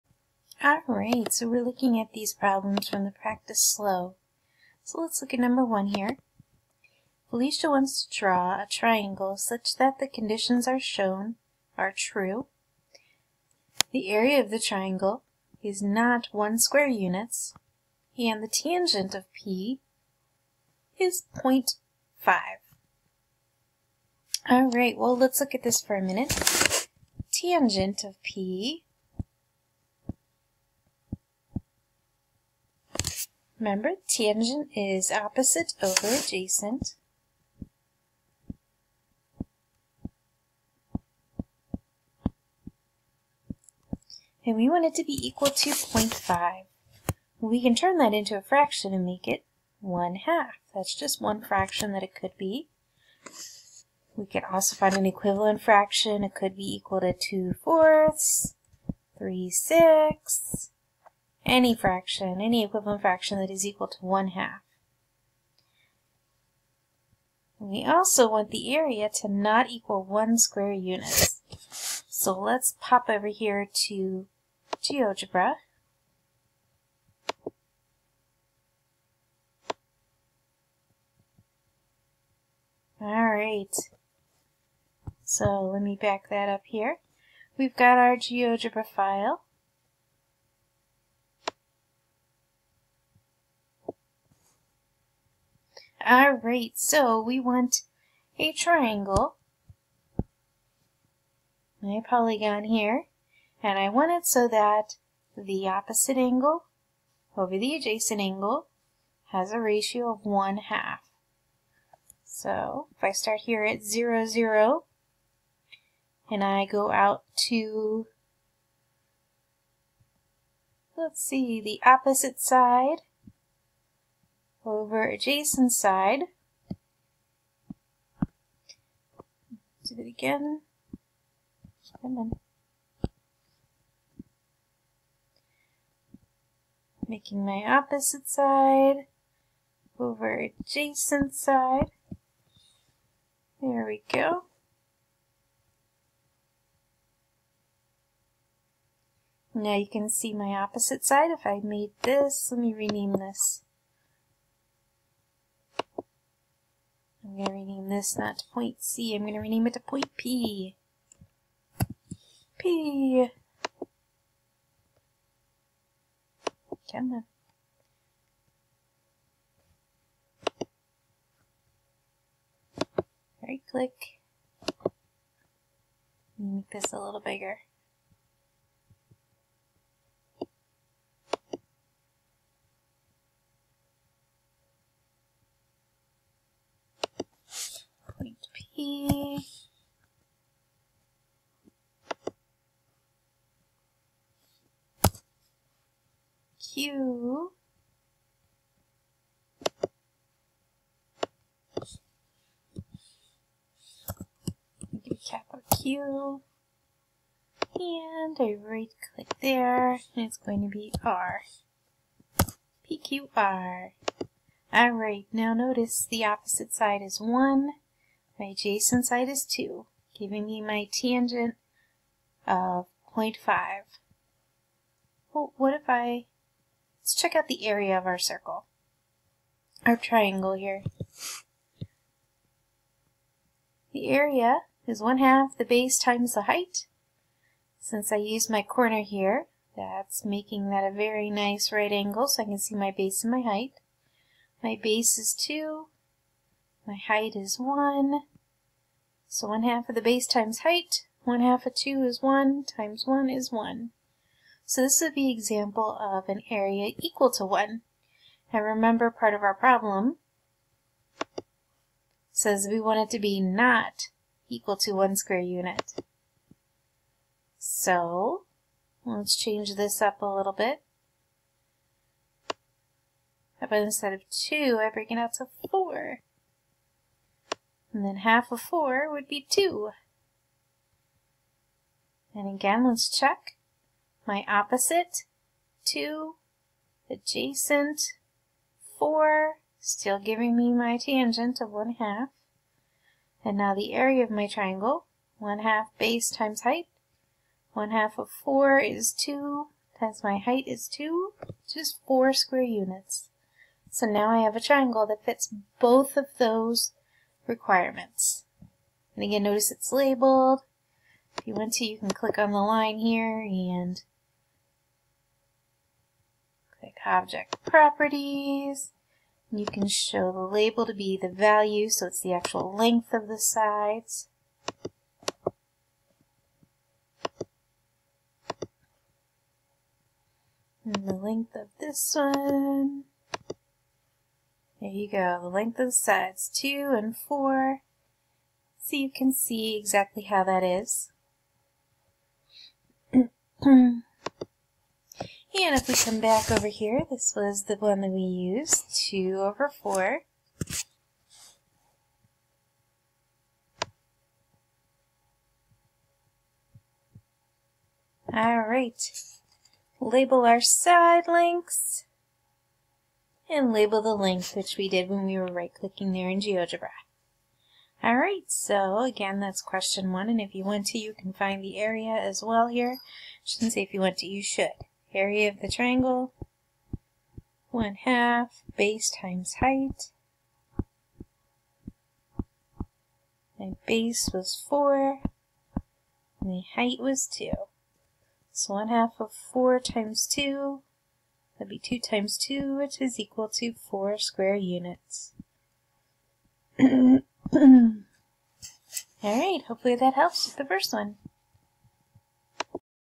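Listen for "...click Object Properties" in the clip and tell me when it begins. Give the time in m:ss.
5:16.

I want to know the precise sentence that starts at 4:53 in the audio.
And now the area of my triangle, 1 half base times height.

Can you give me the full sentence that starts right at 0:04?
So let's look at number one here.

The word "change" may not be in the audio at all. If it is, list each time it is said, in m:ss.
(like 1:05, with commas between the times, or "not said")
4:29.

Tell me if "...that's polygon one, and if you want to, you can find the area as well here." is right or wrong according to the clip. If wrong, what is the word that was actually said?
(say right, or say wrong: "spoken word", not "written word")
wrong: "question", not "polygon".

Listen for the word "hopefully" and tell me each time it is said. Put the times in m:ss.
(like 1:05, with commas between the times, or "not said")
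6:39.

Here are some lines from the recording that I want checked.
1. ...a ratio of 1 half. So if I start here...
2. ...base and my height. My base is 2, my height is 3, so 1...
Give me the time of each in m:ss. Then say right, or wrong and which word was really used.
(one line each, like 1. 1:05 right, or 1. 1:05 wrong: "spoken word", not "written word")
1. 1:49 right
2. 4:02 wrong: "1", not "3".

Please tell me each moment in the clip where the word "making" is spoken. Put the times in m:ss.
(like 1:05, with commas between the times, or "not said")
2:17, 4:00.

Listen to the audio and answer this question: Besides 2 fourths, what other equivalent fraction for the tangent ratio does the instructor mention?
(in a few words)
3 sixths.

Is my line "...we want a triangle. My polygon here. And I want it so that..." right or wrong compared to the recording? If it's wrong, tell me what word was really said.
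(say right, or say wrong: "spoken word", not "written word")
right.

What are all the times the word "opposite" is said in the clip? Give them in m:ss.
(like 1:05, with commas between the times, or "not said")
0:35, 1:45, 2:01, 2:17, 2:30, 3:36, 4:44.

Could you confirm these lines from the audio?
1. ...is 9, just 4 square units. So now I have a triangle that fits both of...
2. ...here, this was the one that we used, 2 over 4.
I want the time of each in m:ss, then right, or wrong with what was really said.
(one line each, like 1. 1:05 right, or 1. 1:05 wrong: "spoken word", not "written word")
1. 5:00 wrong: "2", not "9"
2. 5:46 right.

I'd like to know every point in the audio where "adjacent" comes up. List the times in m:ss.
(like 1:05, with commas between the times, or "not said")
0:36, 1:47, 2:05, 2:20, 3:38, 4:47.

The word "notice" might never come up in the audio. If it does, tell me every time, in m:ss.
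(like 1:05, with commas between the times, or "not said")
3:35, 5:09.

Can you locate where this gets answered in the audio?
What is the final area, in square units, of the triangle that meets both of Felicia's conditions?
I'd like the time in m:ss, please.
6:33.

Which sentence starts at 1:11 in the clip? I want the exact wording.
So let's pop over here to GeoGebra.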